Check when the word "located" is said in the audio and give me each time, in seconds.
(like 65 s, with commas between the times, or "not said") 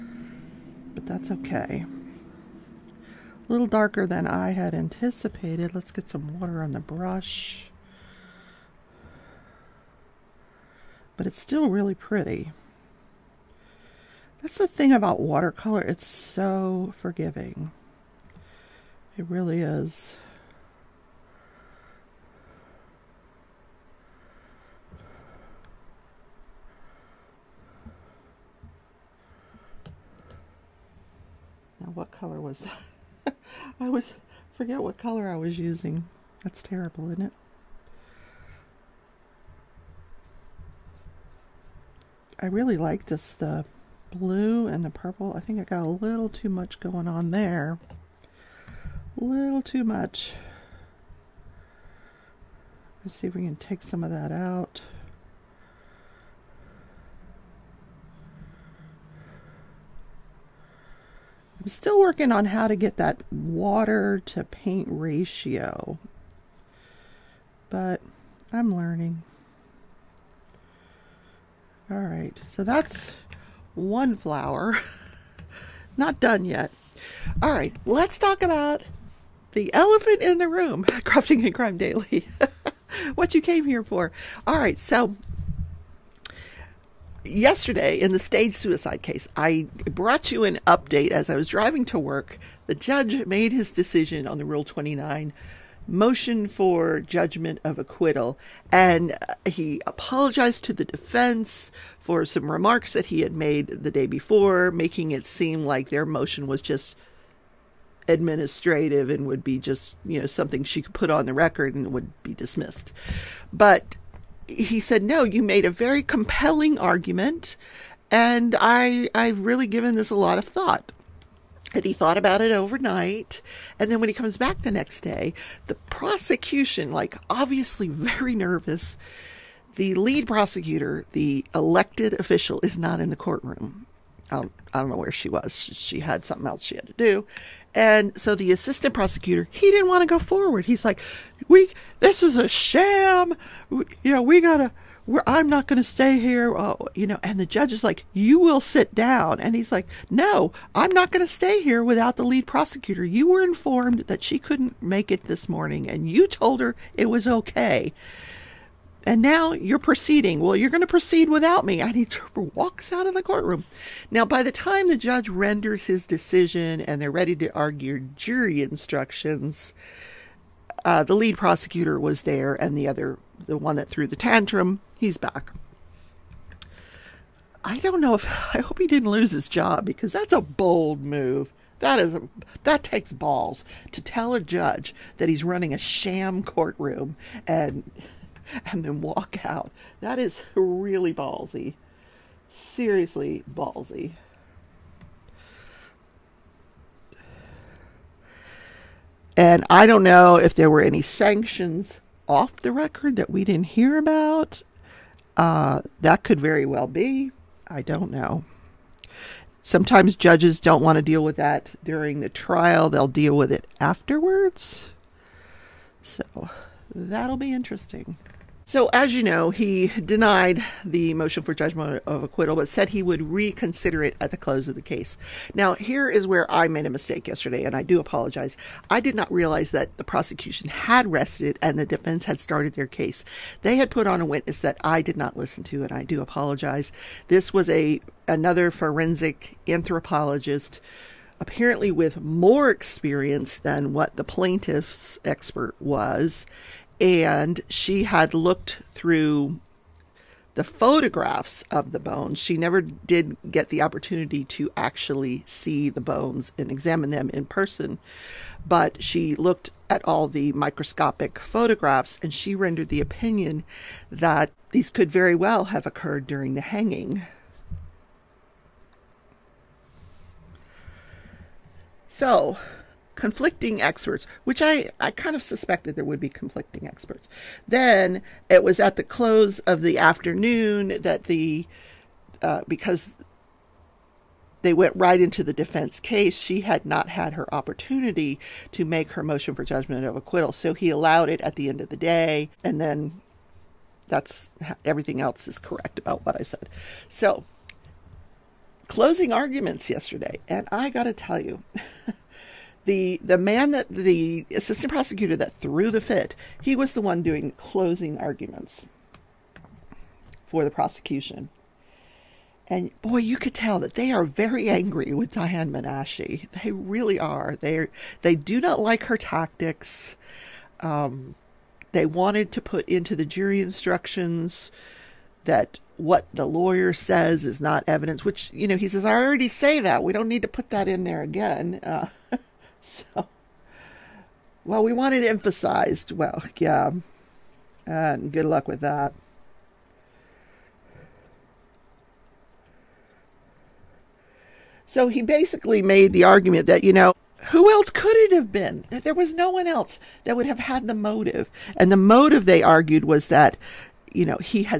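not said.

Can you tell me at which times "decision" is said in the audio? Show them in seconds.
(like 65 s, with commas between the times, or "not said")
93 s, 166 s.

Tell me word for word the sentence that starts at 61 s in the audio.
I'm still working on how to get that water to paint ratio, but I'm learning.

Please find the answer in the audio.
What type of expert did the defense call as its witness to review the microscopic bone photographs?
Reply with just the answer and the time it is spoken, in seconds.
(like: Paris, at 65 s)
forensic anthropologist, at 238 s.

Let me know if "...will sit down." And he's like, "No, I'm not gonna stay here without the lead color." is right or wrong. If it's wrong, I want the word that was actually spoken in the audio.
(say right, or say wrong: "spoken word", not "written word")
wrong: "prosecutor", not "color".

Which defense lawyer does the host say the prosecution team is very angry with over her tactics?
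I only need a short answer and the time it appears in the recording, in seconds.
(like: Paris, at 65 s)
Diane Menashe, at 315 s.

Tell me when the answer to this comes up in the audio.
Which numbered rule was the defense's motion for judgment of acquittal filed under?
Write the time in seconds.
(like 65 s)
94 s.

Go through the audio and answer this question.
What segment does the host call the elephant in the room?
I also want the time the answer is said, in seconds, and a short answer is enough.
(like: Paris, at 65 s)
Crafting and Crime Daily, at 80 s.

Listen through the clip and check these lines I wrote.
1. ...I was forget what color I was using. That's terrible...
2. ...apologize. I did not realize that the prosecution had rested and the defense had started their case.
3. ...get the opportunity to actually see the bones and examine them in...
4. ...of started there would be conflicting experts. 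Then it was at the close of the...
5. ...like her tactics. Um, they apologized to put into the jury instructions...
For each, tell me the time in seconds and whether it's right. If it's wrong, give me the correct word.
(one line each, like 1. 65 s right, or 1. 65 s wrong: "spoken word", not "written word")
1. 33 s right
2. 227 s right
3. 253 s right
4. 275 s wrong: "suspected", not "started"
5. 318 s wrong: "wanted", not "apologized".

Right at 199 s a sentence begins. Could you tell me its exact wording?
And I don't know if there were any sanctions off the record that we didn't hear about.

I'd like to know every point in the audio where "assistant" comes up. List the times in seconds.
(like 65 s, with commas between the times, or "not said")
138 s, 304 s.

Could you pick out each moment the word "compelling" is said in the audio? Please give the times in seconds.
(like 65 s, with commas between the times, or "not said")
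116 s.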